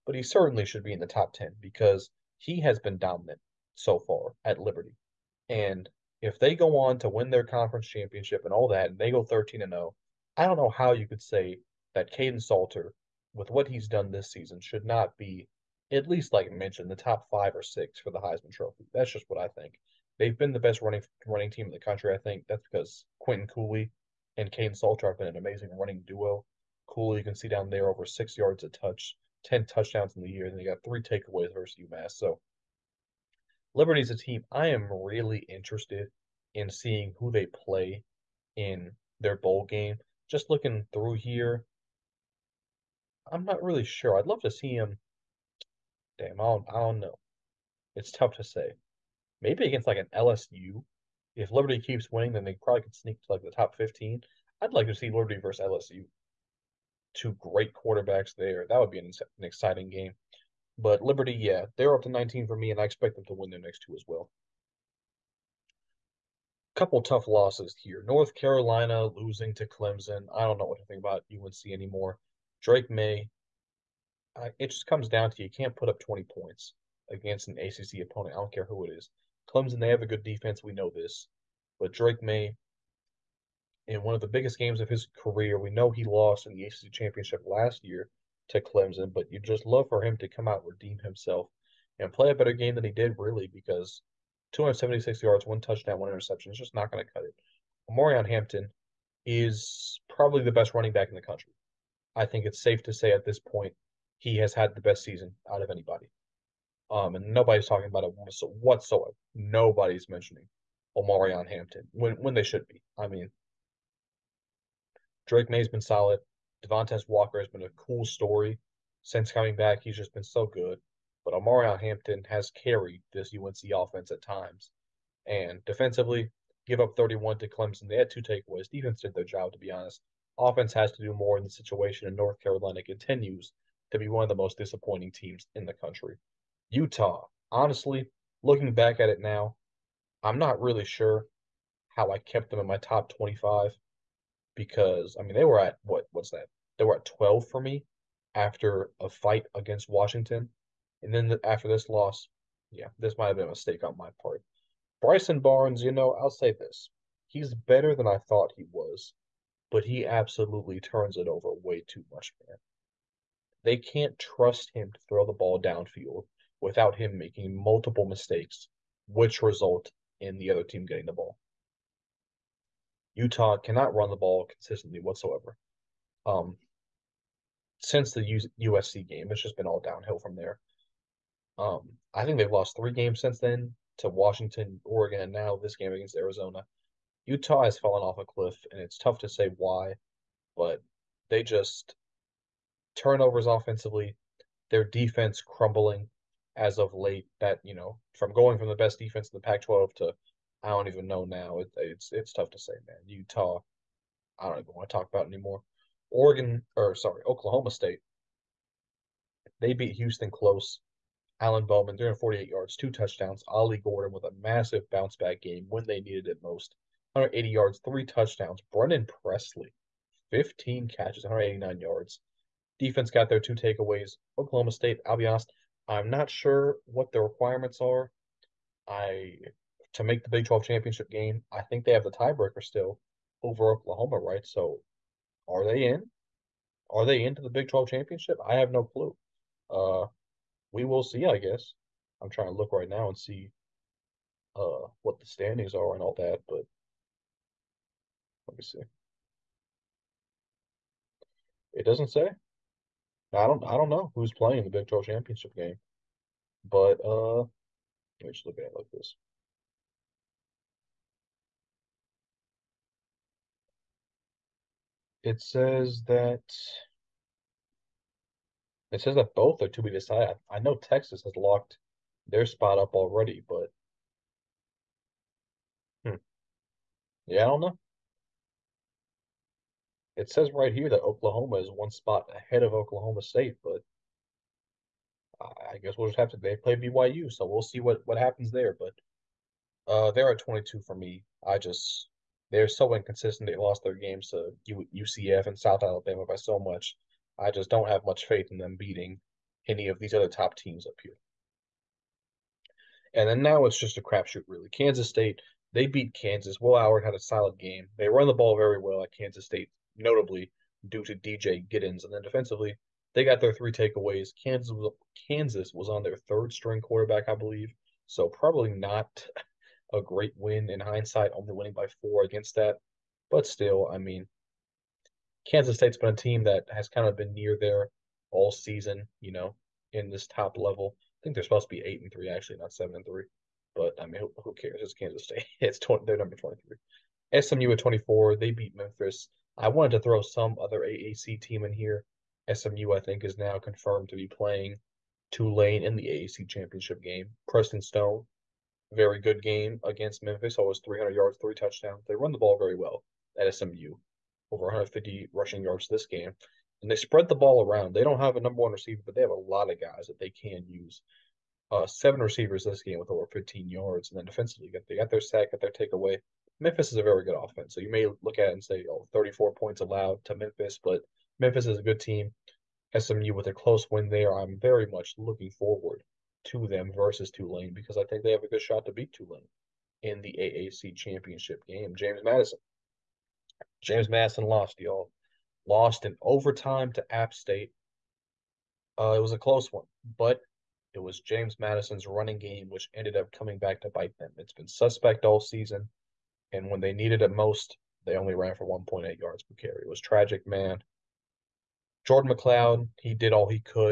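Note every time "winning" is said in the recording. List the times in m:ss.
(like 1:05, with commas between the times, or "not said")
0:52, 5:21.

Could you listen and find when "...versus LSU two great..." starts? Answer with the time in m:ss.
0:55.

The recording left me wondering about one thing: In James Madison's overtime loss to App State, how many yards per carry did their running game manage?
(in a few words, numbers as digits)
1.8.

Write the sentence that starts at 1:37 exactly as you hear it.
Omarion Hampton is probably the best running back in the country.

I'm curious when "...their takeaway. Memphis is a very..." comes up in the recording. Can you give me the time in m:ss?
6:05.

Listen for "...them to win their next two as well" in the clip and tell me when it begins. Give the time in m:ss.
1:03.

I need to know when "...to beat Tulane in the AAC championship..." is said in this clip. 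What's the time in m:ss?
6:18.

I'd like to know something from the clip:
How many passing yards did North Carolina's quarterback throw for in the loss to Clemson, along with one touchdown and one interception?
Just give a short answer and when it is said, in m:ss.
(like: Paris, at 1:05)
276, at 1:34.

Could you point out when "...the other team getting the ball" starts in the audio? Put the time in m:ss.
2:50.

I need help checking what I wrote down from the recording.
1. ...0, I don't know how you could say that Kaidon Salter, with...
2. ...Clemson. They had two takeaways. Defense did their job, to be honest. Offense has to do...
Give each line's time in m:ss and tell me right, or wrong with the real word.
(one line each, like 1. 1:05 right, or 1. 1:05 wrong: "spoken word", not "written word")
1. 0:09 right
2. 2:07 right.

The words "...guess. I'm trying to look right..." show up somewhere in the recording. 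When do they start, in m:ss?
4:01.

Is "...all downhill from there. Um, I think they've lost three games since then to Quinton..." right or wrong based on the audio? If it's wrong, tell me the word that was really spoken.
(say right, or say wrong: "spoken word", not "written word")
wrong: "Washington", not "Quinton".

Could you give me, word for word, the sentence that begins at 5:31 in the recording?
I think they're supposed to be eight and three, actually, not seven and three.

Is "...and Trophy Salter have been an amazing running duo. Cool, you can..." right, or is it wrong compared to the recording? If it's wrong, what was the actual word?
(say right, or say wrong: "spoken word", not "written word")
wrong: "Kaidon", not "Trophy".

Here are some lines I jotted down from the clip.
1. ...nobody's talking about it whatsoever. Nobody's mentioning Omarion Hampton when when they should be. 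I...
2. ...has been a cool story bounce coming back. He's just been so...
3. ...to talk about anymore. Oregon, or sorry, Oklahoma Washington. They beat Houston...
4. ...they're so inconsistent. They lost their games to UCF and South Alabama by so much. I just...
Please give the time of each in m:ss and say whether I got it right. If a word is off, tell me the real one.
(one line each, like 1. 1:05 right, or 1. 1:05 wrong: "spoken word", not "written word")
1. 1:47 right
2. 1:57 wrong: "since", not "bounce"
3. 3:24 wrong: "State", not "Washington"
4. 4:52 right.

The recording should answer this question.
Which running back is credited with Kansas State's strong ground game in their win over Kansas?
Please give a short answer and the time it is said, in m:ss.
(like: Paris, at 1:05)
DJ Giddens, at 5:11.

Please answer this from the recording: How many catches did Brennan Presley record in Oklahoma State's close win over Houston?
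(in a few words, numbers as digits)
15.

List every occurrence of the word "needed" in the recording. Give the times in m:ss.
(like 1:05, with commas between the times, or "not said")
3:36, 6:36.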